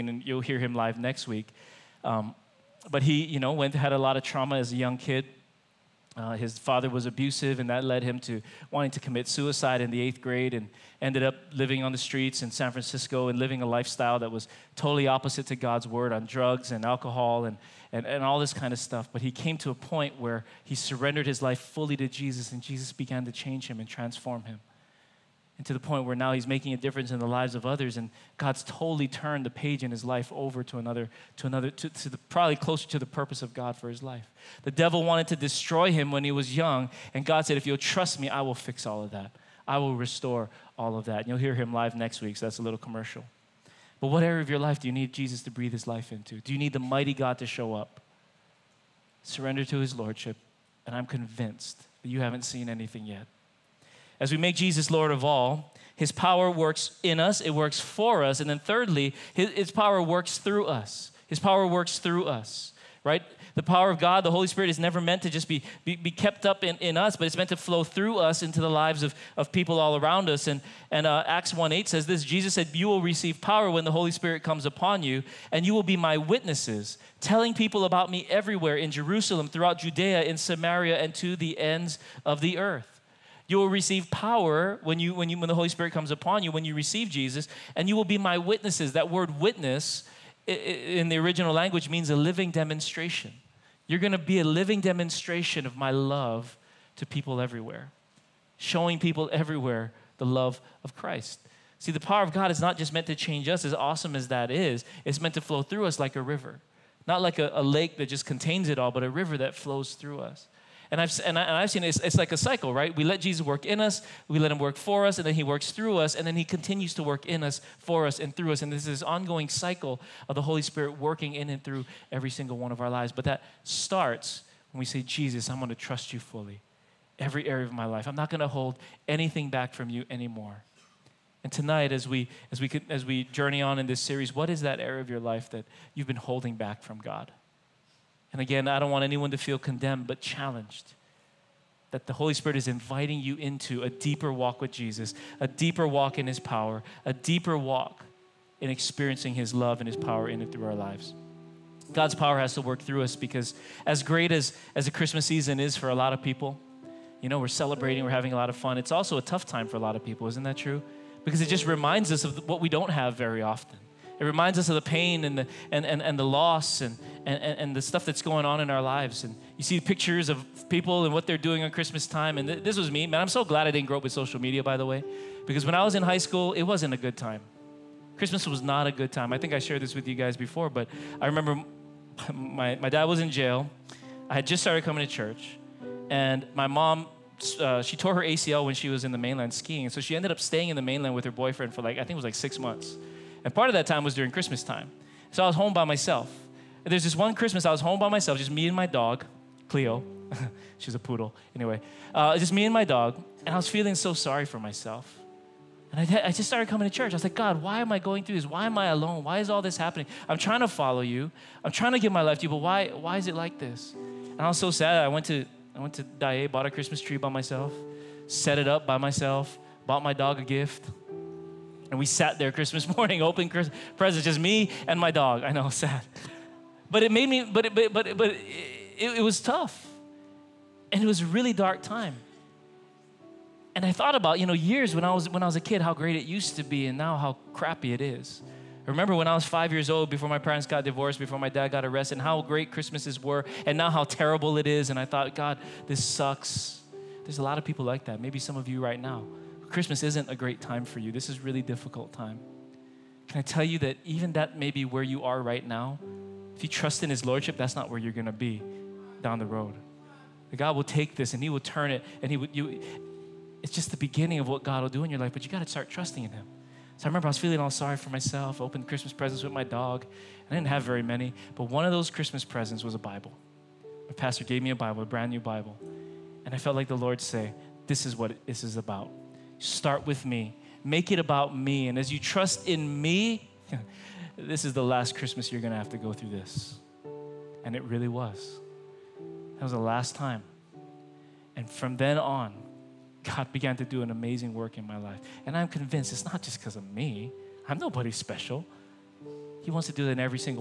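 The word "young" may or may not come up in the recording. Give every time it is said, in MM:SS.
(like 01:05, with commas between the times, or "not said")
00:04, 00:36.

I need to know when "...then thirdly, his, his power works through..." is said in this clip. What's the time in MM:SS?
00:58.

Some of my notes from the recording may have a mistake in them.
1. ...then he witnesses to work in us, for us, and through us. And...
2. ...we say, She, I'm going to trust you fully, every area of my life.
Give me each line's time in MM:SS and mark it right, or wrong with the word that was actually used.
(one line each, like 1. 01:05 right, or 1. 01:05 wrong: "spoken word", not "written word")
1. 01:56 wrong: "continues", not "witnesses"
2. 02:04 wrong: "Jesus", not "She".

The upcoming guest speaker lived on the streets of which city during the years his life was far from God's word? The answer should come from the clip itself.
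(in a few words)
San Francisco.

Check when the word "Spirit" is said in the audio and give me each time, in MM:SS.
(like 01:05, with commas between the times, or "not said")
01:04, 01:14, 01:25, 02:00, 02:22.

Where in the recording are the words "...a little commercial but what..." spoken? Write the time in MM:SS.
00:42.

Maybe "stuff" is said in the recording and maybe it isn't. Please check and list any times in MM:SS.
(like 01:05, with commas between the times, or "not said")
00:18, 02:47.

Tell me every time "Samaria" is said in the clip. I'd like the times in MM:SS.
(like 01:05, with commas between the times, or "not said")
01:20.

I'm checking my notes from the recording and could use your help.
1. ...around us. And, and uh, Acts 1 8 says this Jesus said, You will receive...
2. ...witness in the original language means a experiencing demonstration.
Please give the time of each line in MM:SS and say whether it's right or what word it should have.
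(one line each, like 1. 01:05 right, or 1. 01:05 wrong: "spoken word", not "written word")
1. 01:09 right
2. 01:29 wrong: "living", not "experiencing".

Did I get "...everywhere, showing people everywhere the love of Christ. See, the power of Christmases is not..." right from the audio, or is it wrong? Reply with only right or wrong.
wrong.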